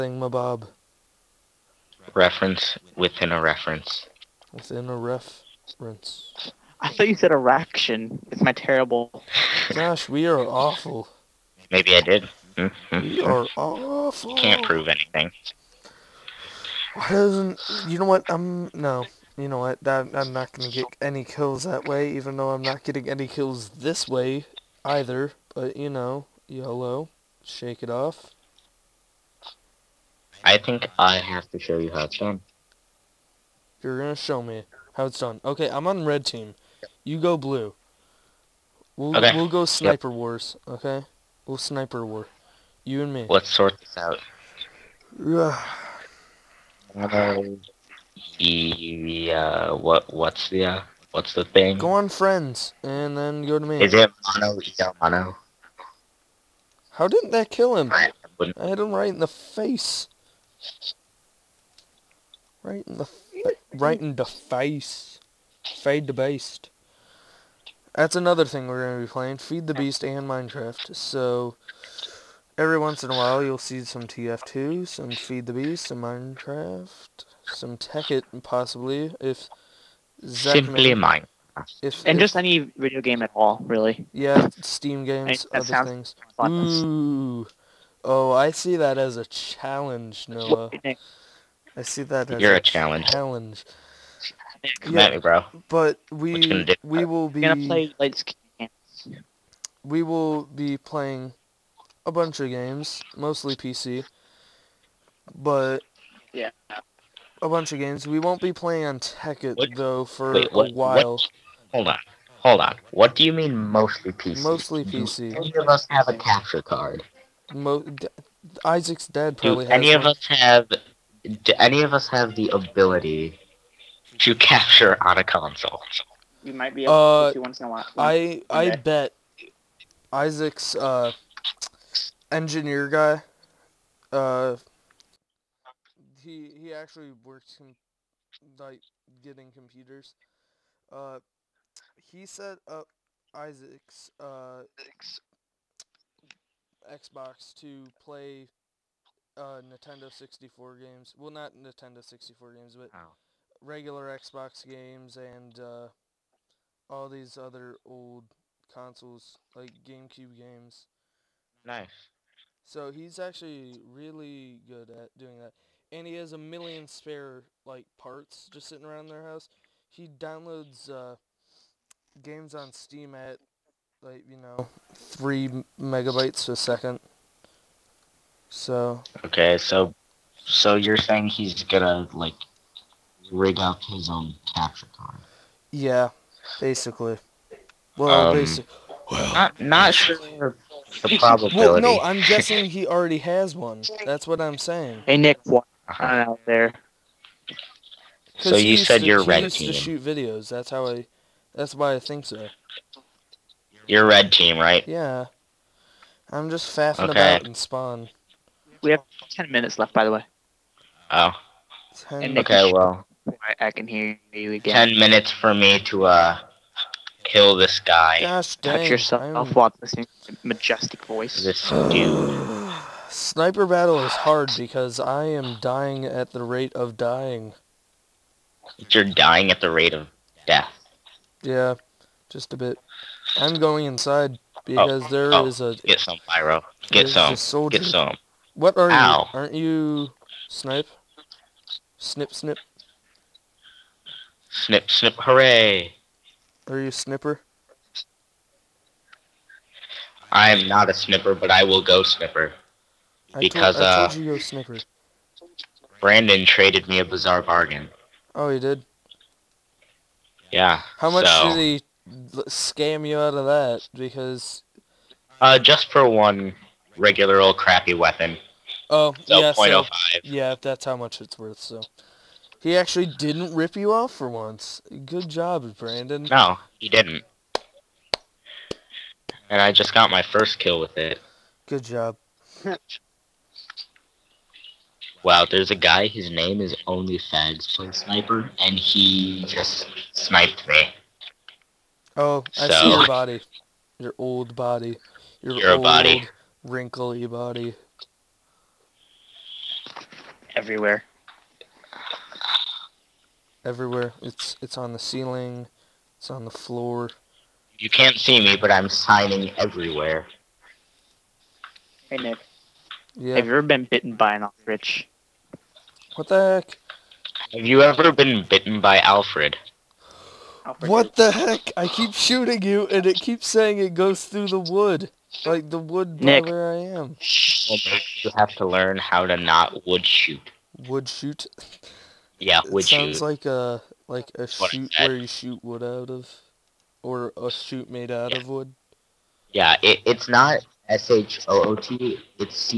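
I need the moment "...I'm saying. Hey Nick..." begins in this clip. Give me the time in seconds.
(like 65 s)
194 s.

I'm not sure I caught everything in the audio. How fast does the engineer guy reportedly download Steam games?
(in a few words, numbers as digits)
3 megabytes a second.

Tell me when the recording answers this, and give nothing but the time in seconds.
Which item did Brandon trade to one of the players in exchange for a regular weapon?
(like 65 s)
257 s.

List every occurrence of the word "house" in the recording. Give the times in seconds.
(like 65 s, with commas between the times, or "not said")
169 s.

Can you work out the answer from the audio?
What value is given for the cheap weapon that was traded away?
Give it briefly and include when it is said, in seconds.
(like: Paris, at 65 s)
0.05, at 269 s.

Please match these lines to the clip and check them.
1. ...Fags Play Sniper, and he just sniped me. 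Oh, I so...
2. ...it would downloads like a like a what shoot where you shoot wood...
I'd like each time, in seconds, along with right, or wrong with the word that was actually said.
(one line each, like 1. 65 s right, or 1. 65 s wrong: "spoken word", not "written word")
1. 287 s right
2. 332 s wrong: "sounds", not "downloads".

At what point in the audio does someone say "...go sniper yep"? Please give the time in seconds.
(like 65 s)
39 s.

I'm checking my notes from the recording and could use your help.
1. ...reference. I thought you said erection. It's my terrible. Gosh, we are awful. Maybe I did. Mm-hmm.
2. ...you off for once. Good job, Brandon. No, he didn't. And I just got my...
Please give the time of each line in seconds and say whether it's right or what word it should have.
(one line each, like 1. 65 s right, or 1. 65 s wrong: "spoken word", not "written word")
1. 4 s right
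2. 273 s right.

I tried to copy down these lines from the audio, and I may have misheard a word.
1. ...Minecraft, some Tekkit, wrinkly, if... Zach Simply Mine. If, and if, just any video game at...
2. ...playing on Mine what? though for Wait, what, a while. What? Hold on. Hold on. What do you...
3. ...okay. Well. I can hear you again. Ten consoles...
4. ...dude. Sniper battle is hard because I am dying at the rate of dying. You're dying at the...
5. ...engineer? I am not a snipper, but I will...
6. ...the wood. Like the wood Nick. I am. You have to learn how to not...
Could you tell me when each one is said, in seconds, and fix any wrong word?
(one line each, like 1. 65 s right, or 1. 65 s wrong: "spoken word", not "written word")
1. 76 s wrong: "possibly", not "wrinkly"
2. 108 s wrong: "Tekkit", not "Mine"
3. 212 s wrong: "minutes", not "consoles"
4. 221 s right
5. 246 s wrong: "snipper", not "engineer"
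6. 324 s right.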